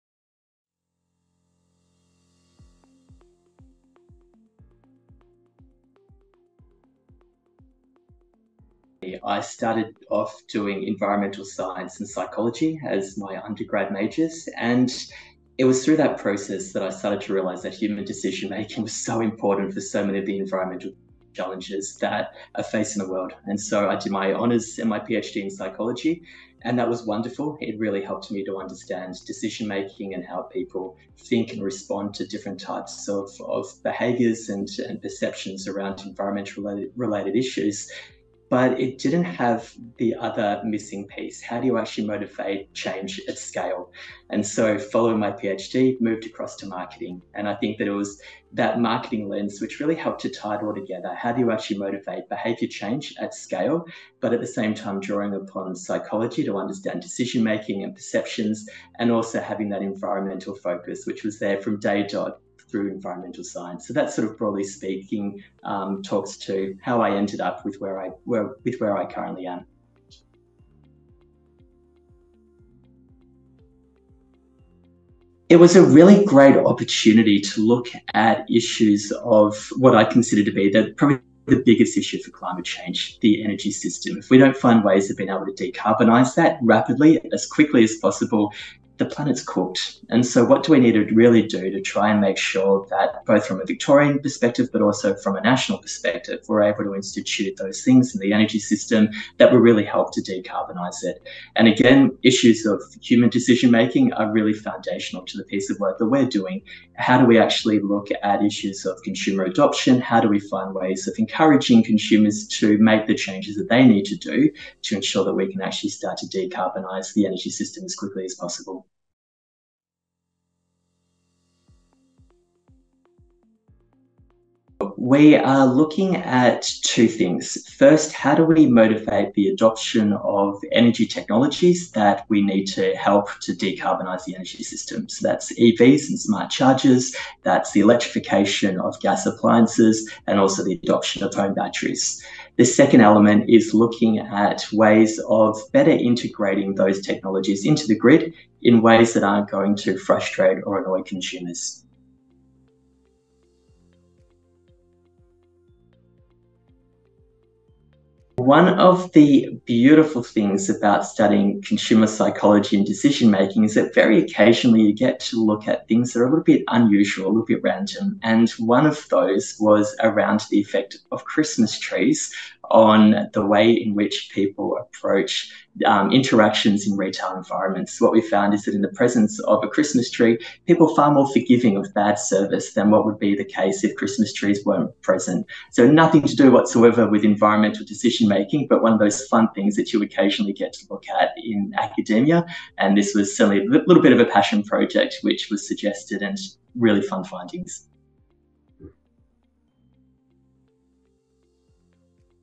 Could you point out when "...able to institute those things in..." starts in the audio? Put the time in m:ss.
1:36.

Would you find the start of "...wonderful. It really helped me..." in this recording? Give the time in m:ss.
0:27.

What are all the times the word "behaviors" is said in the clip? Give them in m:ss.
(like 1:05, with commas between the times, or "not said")
0:33, 0:52.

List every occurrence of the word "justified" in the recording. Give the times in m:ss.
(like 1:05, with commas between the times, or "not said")
not said.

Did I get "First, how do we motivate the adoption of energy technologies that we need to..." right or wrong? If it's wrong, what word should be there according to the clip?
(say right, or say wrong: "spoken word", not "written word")
right.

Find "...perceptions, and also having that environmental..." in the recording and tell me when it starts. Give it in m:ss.
0:57.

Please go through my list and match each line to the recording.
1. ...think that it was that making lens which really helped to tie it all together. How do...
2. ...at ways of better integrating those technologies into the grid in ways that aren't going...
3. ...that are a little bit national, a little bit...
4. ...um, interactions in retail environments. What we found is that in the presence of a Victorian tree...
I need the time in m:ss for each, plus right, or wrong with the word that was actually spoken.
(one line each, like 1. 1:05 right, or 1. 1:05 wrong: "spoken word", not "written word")
1. 0:47 wrong: "marketing", not "making"
2. 2:24 right
3. 2:46 wrong: "unusual", not "national"
4. 2:55 wrong: "Christmas", not "Victorian".